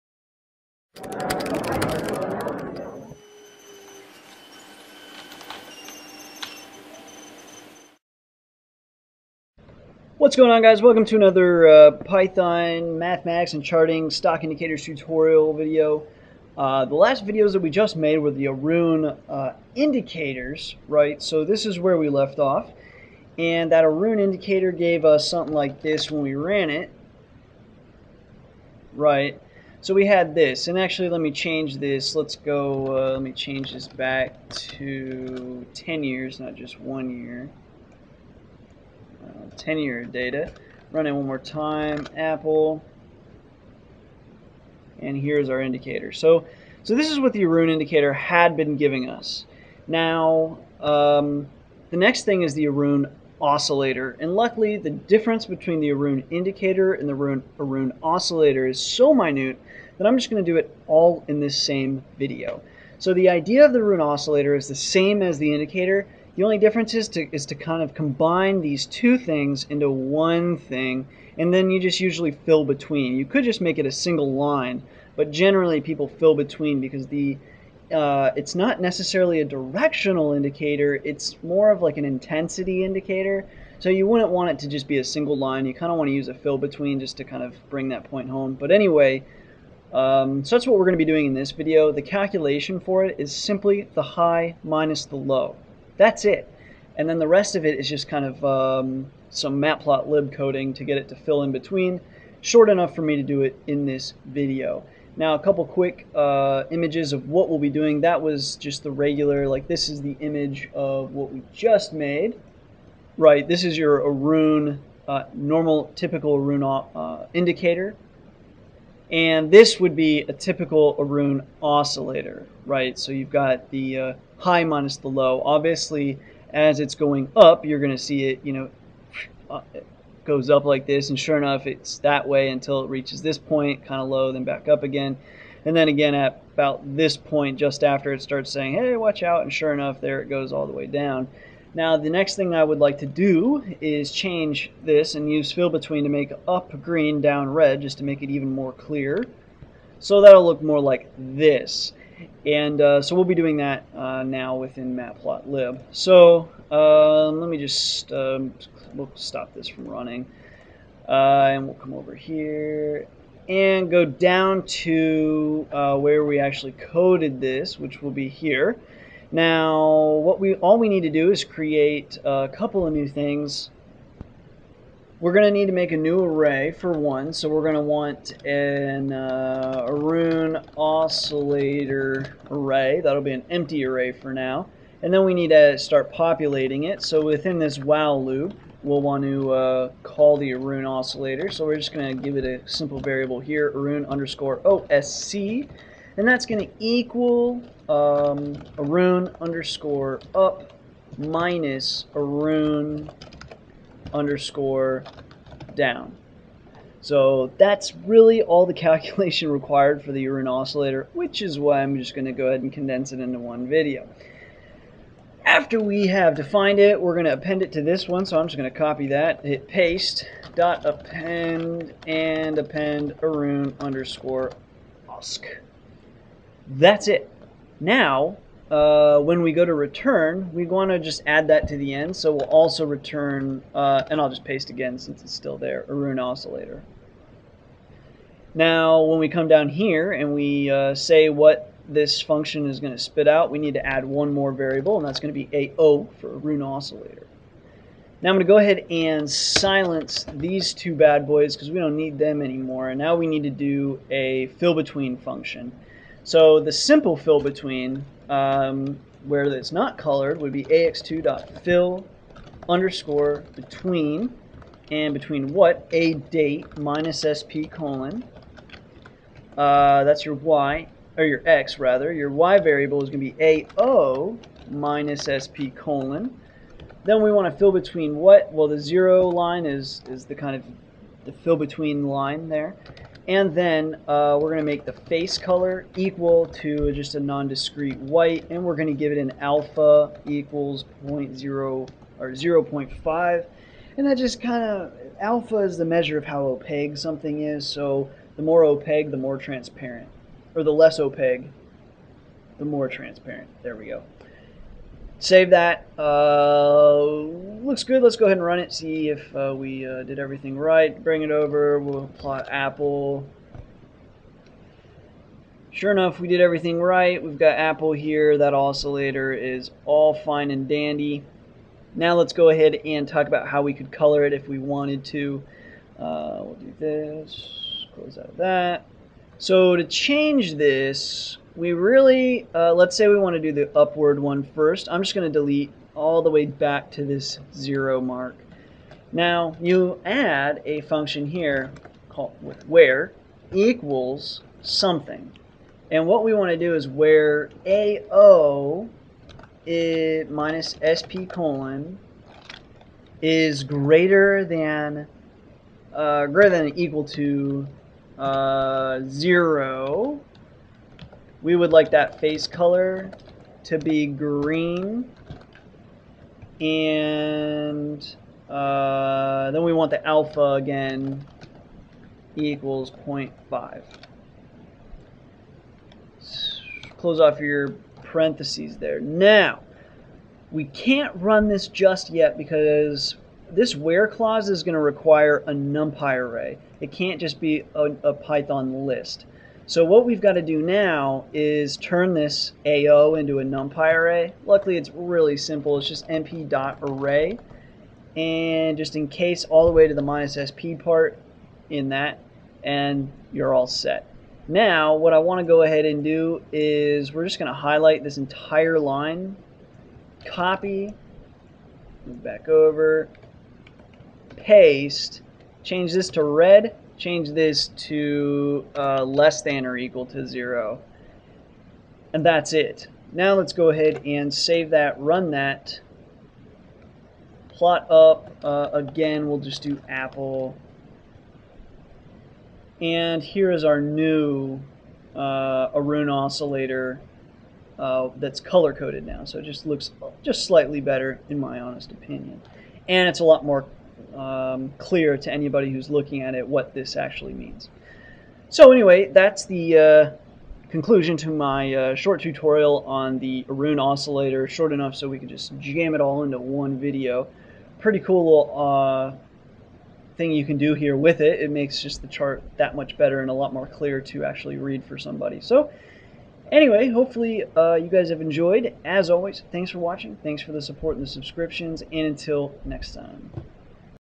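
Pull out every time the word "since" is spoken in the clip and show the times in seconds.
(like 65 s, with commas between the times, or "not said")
234 s.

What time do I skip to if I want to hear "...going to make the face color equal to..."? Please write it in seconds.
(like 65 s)
284 s.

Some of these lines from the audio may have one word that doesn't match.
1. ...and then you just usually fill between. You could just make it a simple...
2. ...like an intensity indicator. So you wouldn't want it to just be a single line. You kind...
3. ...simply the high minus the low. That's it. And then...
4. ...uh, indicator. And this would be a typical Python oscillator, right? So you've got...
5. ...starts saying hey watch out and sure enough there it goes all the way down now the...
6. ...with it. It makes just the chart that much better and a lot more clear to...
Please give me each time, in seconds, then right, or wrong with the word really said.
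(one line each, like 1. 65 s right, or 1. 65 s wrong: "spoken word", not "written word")
1. 71 s wrong: "single", not "simple"
2. 81 s right
3. 93 s right
4. 116 s wrong: "Aroon", not "Python"
5. 138 s right
6. 460 s right.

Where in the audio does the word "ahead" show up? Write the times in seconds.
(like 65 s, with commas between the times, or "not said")
212 s, 248 s, 308 s, 322 s, 405 s, 423 s.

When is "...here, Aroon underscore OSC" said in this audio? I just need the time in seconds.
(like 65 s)
193 s.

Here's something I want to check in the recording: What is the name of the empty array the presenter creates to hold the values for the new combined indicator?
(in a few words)
Aroon oscillator array.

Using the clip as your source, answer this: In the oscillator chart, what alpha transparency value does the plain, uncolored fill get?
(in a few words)
0.5.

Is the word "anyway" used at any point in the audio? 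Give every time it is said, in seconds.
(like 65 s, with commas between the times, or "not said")
88 s, 448 s, 466 s.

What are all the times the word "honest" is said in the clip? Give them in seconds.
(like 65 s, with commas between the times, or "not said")
441 s.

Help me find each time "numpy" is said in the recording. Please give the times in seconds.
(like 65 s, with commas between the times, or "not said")
385 s, 393 s.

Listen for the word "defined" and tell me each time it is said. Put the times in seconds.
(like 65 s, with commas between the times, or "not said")
216 s.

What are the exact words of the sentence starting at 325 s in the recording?
Uh, we'll do this, close out of that.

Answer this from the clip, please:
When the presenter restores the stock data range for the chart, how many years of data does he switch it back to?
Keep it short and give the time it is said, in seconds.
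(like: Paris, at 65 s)
10 years, at 35 s.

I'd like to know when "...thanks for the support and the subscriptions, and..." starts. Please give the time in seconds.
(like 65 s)
470 s.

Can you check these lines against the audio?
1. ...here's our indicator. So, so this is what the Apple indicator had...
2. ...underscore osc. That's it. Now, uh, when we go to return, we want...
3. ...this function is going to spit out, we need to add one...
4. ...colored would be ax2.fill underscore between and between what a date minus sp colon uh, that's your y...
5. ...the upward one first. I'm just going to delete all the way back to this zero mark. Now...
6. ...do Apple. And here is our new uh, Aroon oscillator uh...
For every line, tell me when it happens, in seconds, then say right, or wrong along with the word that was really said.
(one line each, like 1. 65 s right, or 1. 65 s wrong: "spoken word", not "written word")
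1. 45 s wrong: "Aroon", not "Apple"
2. 223 s right
3. 241 s right
4. 259 s right
5. 333 s right
6. 429 s right.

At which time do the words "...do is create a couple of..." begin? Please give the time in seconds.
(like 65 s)
171 s.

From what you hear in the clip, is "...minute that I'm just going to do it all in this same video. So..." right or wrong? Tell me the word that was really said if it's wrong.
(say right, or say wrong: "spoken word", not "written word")
right.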